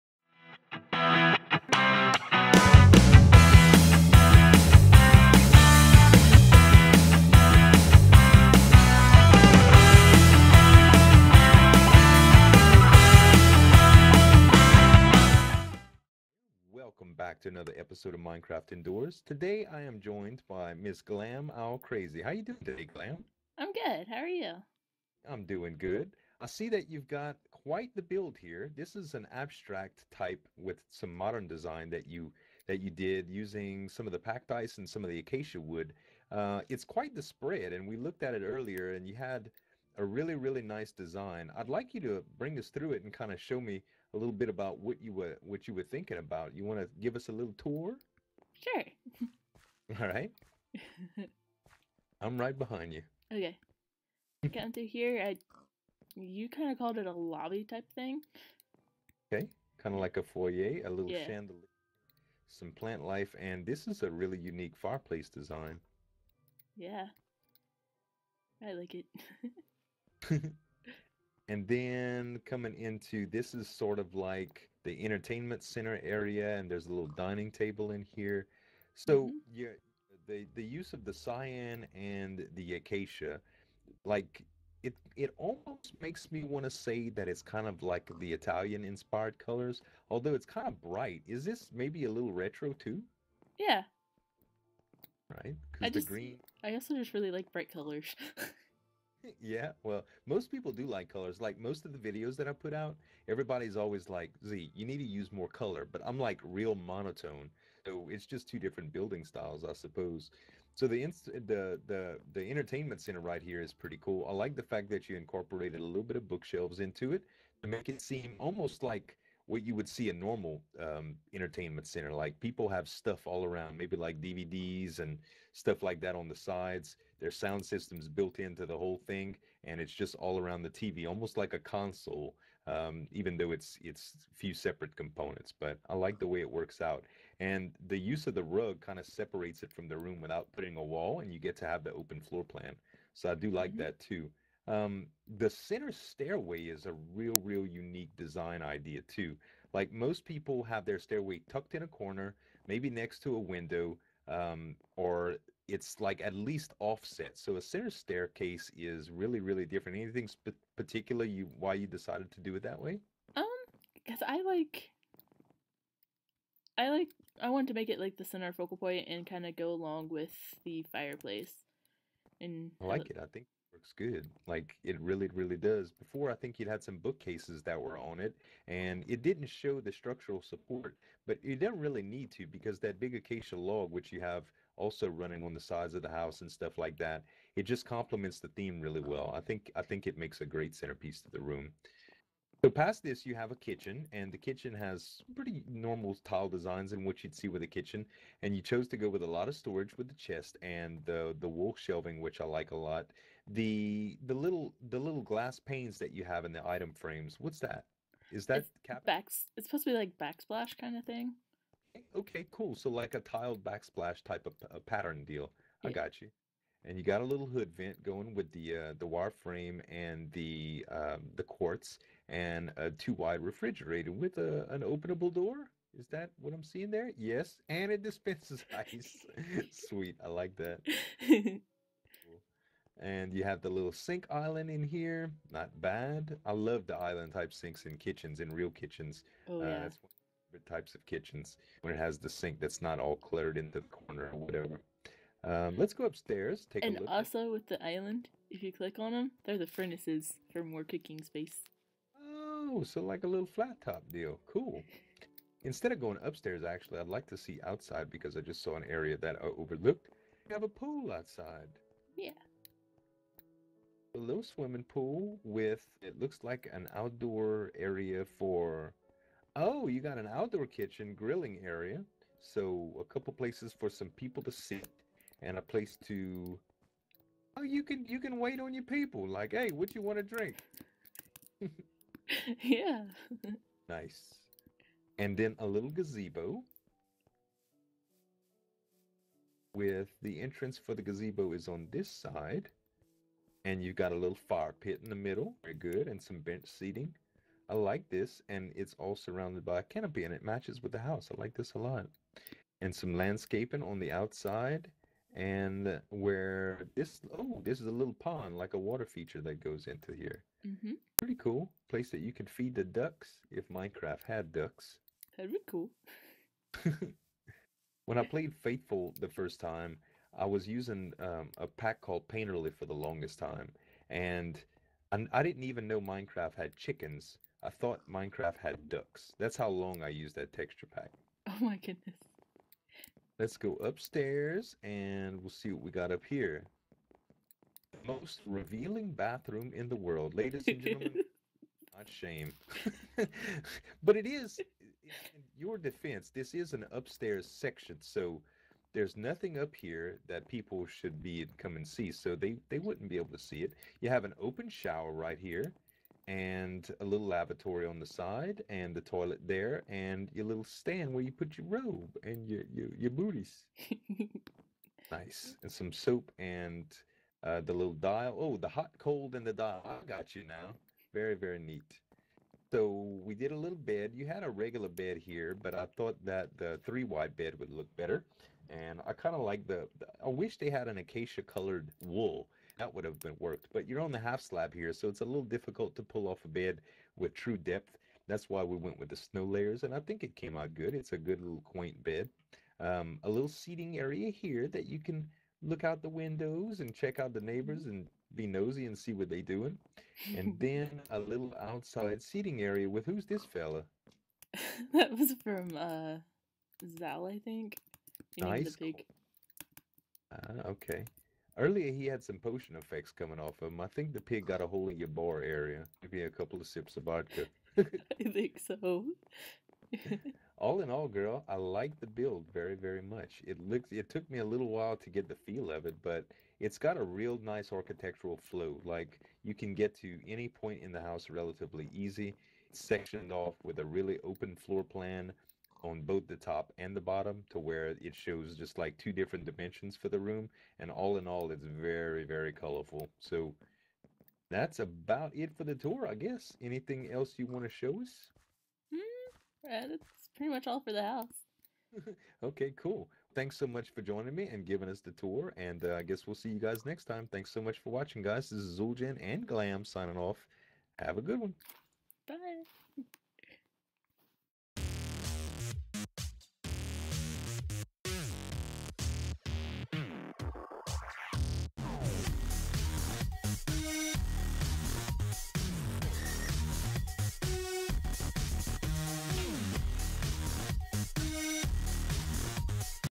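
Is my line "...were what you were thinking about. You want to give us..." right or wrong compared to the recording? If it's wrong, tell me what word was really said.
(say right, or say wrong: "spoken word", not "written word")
right.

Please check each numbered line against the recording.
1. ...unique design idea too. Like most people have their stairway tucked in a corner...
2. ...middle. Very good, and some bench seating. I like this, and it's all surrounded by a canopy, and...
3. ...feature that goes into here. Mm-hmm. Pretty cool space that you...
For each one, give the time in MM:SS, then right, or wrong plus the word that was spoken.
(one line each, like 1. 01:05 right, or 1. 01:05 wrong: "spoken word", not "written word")
1. 02:27 right
2. 04:55 right
3. 05:09 wrong: "place", not "space".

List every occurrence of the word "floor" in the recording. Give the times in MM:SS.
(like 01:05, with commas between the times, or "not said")
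02:22, 07:14.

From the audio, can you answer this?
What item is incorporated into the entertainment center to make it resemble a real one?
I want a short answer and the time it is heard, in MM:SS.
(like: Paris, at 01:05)
Bookshelves, at 01:56.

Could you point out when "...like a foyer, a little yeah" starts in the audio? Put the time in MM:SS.
01:00.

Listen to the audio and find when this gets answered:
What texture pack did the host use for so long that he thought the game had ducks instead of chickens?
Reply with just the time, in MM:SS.
05:22.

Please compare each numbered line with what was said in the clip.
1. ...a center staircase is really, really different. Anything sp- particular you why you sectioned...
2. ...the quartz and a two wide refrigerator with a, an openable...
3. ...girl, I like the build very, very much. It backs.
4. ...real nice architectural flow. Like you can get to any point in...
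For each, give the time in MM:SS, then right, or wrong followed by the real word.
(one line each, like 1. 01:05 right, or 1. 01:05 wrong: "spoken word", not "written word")
1. 02:37 wrong: "decided", not "sectioned"
2. 03:41 right
3. 07:01 wrong: "looks", not "backs"
4. 07:07 right.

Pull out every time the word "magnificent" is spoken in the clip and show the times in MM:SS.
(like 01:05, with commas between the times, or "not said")
not said.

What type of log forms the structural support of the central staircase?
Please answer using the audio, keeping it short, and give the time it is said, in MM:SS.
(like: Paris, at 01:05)
Acacia log, at 03:03.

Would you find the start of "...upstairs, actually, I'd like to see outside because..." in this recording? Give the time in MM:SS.
04:16.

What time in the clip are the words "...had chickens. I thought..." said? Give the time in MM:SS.
05:26.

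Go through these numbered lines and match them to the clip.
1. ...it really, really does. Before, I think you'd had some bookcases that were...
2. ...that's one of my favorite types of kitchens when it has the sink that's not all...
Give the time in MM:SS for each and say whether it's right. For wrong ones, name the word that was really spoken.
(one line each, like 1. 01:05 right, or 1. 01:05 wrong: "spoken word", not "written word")
1. 02:54 right
2. 03:59 right.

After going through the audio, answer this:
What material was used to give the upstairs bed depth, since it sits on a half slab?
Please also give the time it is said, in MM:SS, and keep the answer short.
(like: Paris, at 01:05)
Snow layers, at 06:29.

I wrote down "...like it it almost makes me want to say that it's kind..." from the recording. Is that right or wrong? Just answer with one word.
right.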